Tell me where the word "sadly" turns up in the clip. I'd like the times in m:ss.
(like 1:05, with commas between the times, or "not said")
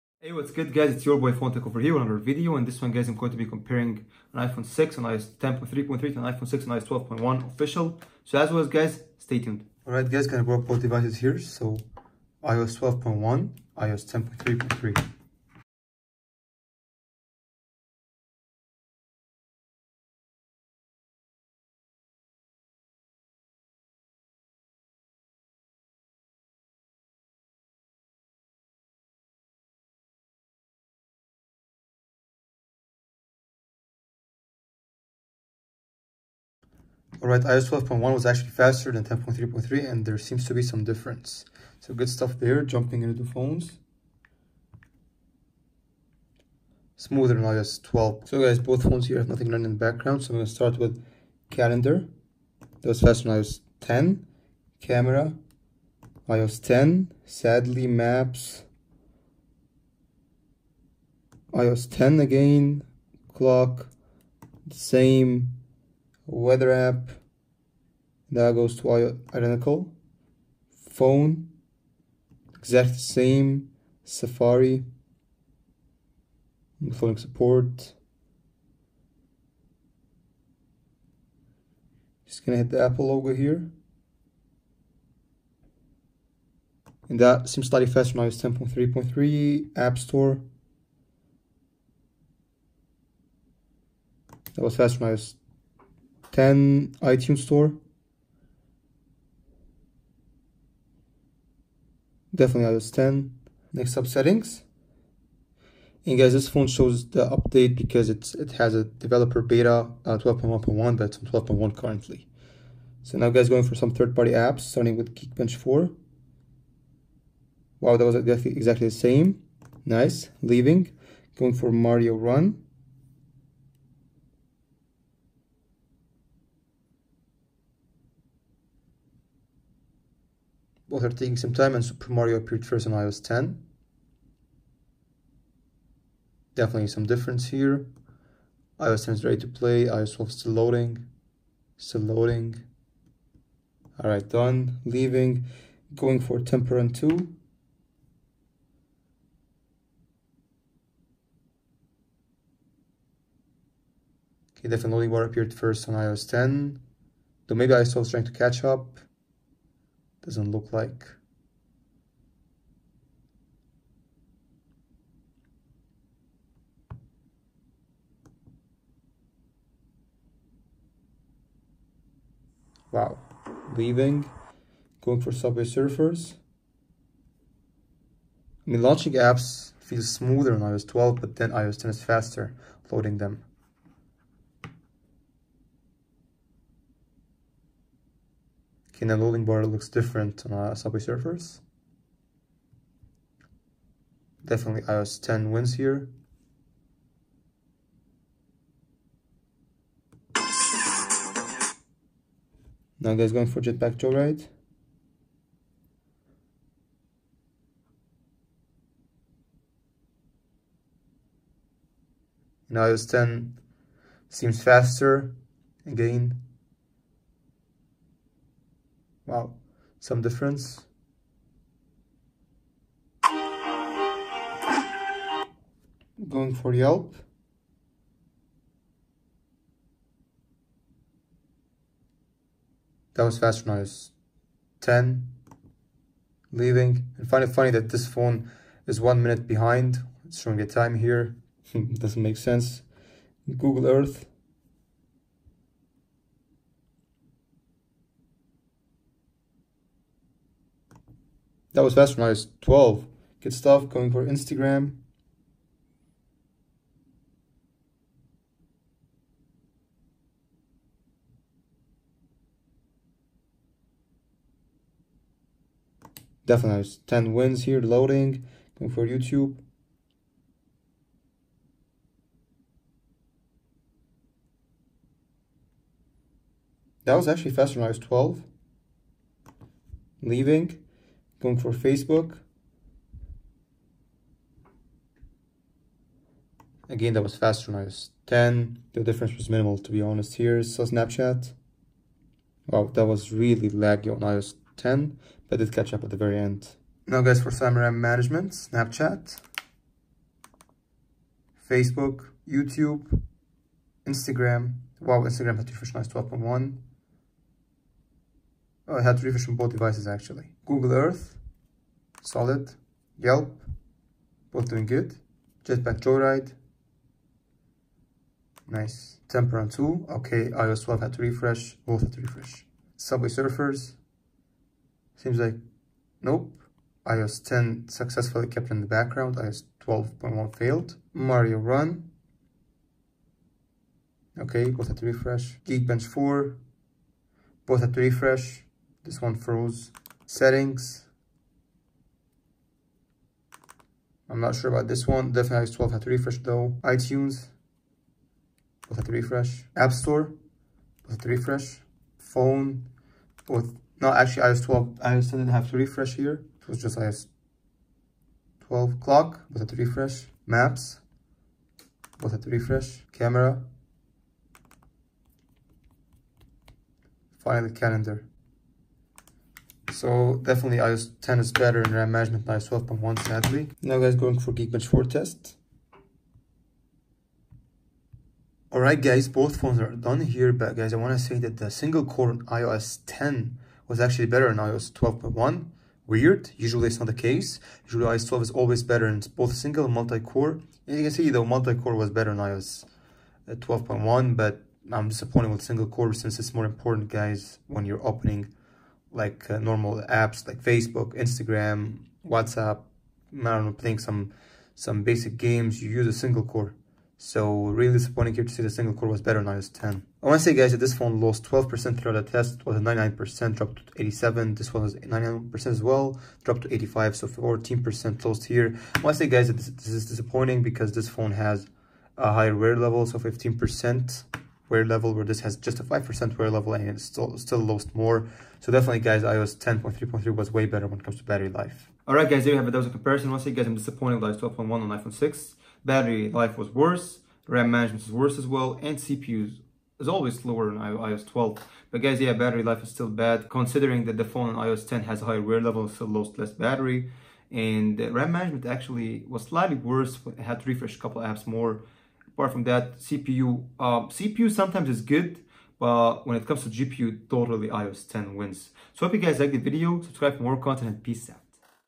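0:57, 6:13.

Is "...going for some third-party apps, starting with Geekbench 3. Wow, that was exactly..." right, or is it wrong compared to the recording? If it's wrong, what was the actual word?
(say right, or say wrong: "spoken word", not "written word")
wrong: "4", not "3".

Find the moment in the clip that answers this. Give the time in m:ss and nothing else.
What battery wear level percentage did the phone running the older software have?
7:03.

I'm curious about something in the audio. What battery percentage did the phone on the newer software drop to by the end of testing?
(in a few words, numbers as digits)
85.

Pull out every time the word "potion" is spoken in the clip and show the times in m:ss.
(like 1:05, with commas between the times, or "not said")
not said.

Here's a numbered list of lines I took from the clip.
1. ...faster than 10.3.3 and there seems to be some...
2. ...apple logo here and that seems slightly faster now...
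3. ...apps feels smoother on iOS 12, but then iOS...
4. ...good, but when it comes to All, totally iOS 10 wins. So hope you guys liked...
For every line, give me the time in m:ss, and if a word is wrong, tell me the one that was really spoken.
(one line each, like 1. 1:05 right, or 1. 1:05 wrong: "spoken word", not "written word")
1. 0:38 right
2. 1:22 right
3. 2:59 right
4. 7:35 wrong: "GPU", not "All".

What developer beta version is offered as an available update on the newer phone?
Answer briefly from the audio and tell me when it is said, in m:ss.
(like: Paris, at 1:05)
12.1.1, at 1:50.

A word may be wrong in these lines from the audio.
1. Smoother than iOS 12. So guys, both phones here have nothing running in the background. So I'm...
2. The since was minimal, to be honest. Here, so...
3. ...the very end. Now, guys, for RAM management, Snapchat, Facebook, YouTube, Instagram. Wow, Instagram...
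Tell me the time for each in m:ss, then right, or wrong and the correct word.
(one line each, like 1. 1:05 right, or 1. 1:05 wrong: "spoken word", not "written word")
1. 0:46 right
2. 4:48 wrong: "difference", not "since"
3. 4:56 right.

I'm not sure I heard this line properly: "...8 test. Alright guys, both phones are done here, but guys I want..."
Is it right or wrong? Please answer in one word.
wrong.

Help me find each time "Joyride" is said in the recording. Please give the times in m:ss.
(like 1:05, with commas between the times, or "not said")
3:23, 5:16.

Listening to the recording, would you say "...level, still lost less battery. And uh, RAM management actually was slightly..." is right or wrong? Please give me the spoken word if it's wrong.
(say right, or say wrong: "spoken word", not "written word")
right.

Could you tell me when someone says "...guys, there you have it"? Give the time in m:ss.
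7:12.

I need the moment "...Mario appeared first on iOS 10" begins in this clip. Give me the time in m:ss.
2:12.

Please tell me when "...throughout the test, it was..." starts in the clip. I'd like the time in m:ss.
6:51.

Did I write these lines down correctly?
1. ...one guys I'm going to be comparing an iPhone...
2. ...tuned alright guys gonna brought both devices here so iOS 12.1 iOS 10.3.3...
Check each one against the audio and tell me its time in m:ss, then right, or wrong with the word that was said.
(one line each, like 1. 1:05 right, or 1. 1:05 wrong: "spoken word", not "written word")
1. 0:02 right
2. 0:09 right.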